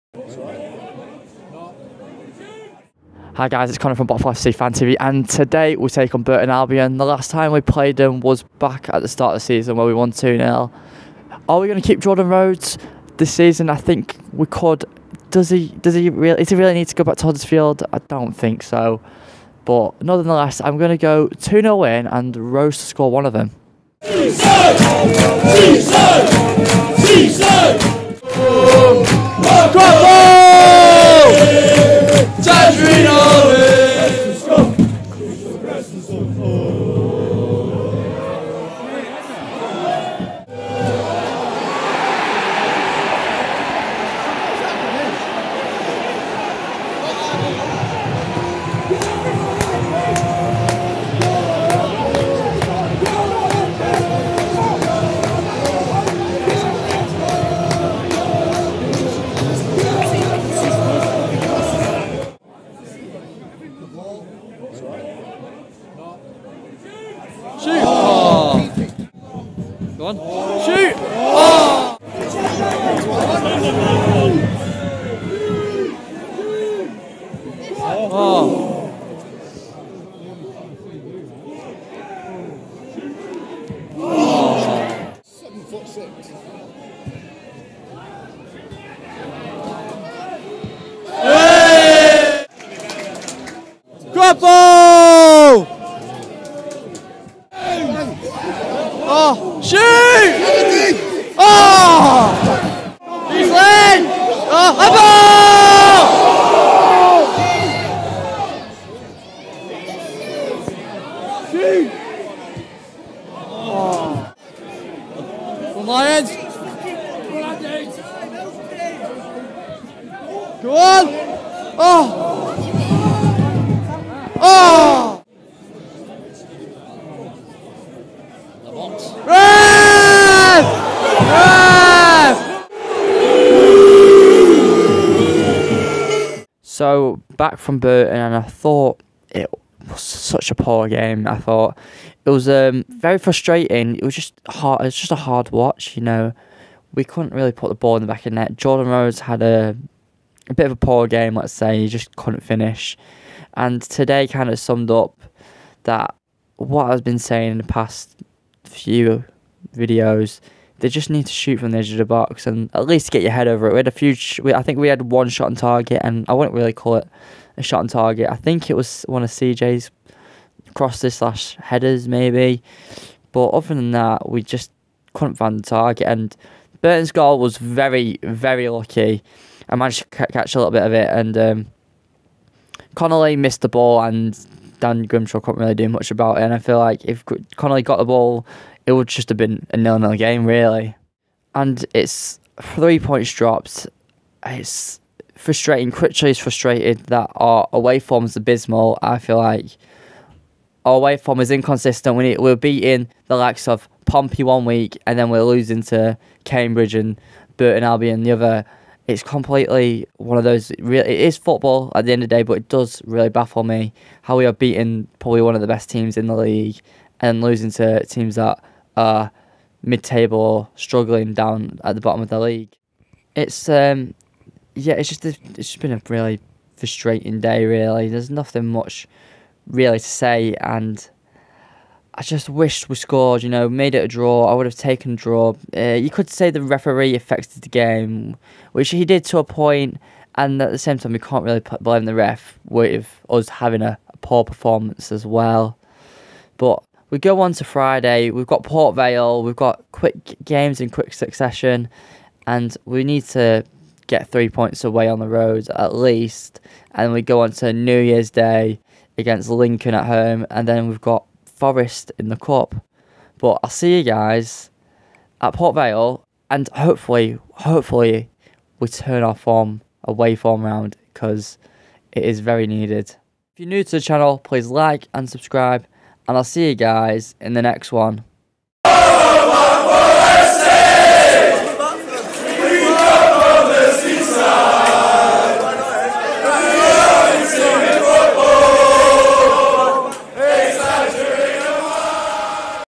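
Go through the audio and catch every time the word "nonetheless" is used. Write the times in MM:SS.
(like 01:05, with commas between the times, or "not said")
00:20.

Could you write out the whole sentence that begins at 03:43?
It's um, yeah, it's just a, it's just been a really frustrating day.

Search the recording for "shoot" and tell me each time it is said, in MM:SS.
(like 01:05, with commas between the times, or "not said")
01:04, 01:10, 01:39, 01:51, 02:41.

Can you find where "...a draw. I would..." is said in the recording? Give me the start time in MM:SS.
03:54.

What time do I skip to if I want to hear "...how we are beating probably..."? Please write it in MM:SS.
03:34.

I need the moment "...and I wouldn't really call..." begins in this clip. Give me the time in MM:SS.
02:46.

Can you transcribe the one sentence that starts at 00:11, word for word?
Are we going to keep Jordan Rhodes this season?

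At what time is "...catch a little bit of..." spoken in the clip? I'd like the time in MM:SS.
03:00.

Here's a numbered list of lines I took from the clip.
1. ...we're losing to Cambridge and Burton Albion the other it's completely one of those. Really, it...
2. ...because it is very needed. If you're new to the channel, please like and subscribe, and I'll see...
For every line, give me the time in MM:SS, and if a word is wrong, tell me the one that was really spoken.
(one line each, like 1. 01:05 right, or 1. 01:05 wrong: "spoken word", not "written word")
1. 03:25 right
2. 04:31 right.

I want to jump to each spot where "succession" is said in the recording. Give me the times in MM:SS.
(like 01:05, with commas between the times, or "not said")
04:11.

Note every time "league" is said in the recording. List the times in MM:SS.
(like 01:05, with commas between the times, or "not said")
03:36, 03:42.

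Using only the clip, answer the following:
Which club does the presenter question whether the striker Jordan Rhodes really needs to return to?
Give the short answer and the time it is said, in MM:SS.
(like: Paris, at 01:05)
Huddersfield, at 00:17.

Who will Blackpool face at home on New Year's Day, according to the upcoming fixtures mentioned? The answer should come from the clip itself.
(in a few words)
Lincoln.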